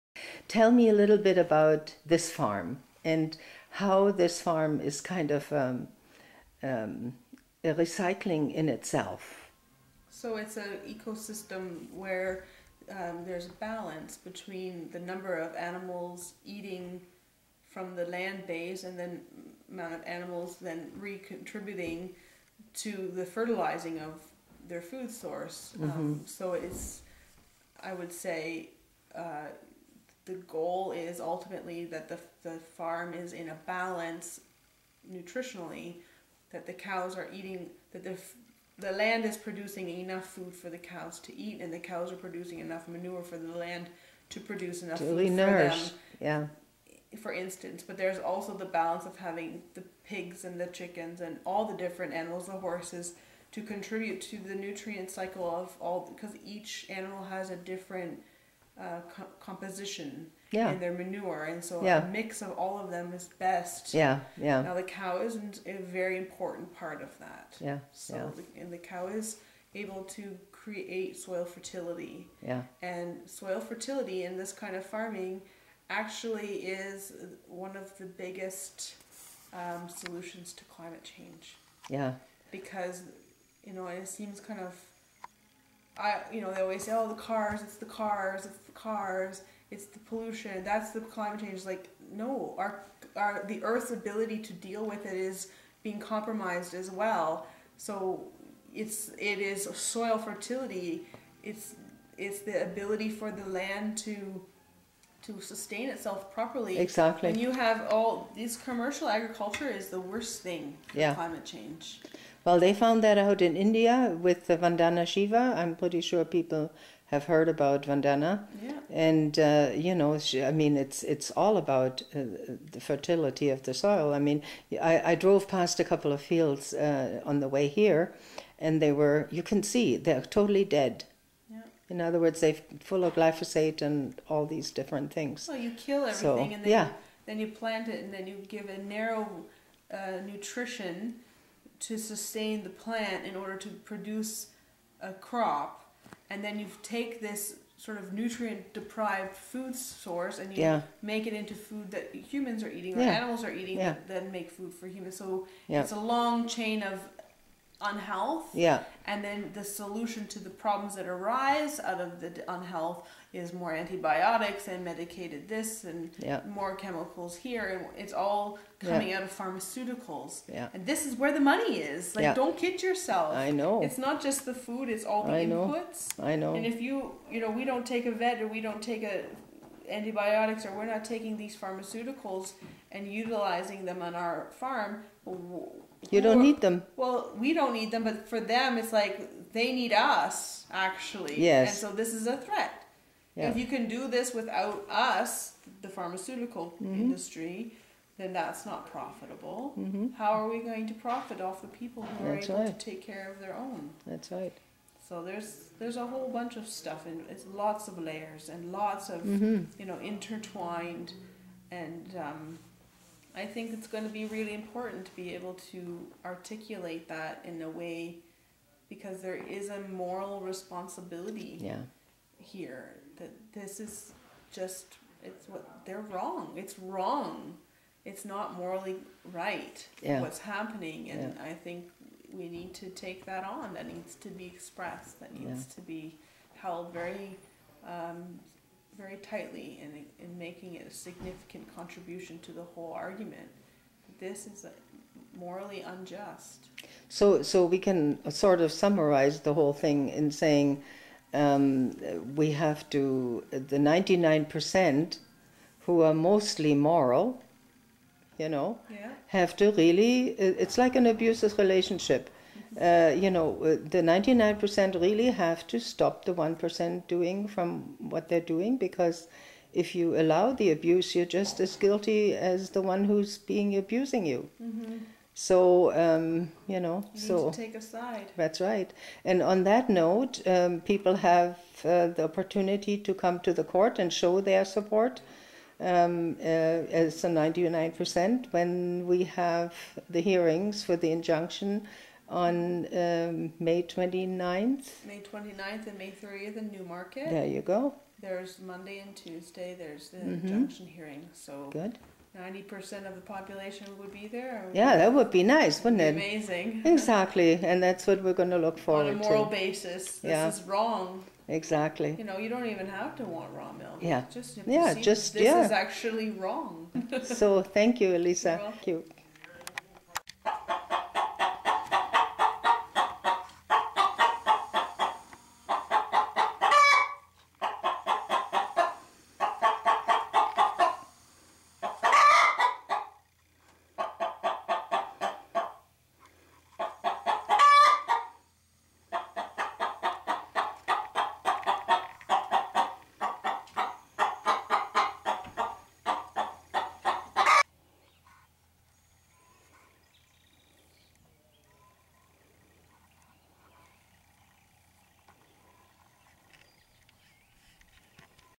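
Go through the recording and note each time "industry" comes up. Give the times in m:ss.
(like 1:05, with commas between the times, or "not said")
3:17.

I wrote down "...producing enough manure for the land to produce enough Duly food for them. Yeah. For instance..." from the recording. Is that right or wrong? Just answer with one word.
right.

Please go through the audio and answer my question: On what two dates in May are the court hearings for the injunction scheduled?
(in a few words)
May 29 and May 30.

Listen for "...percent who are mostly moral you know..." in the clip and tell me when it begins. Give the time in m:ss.
4:14.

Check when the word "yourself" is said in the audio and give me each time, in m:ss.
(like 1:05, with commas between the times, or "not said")
2:52.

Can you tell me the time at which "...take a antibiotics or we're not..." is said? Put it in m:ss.
2:58.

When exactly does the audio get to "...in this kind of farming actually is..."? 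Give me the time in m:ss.
1:14.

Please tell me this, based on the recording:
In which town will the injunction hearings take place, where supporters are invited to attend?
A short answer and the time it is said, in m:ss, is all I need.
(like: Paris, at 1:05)
Newmarket, at 4:56.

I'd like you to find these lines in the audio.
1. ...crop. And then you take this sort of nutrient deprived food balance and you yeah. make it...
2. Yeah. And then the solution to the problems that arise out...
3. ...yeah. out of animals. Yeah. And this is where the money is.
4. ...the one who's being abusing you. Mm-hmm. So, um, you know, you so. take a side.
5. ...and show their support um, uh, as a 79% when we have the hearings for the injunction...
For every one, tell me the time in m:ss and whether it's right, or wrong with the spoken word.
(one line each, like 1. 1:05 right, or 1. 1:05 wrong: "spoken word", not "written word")
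1. 2:25 wrong: "source", not "balance"
2. 2:38 right
3. 2:49 wrong: "pharmaceuticals", not "animals"
4. 4:32 right
5. 4:43 wrong: "99", not "79".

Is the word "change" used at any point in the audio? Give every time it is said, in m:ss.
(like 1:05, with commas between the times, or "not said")
1:21, 1:31, 1:51.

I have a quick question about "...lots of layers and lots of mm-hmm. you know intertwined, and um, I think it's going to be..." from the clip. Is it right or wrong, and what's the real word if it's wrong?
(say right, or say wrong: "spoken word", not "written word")
right.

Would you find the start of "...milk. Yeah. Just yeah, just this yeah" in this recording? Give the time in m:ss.
5:13.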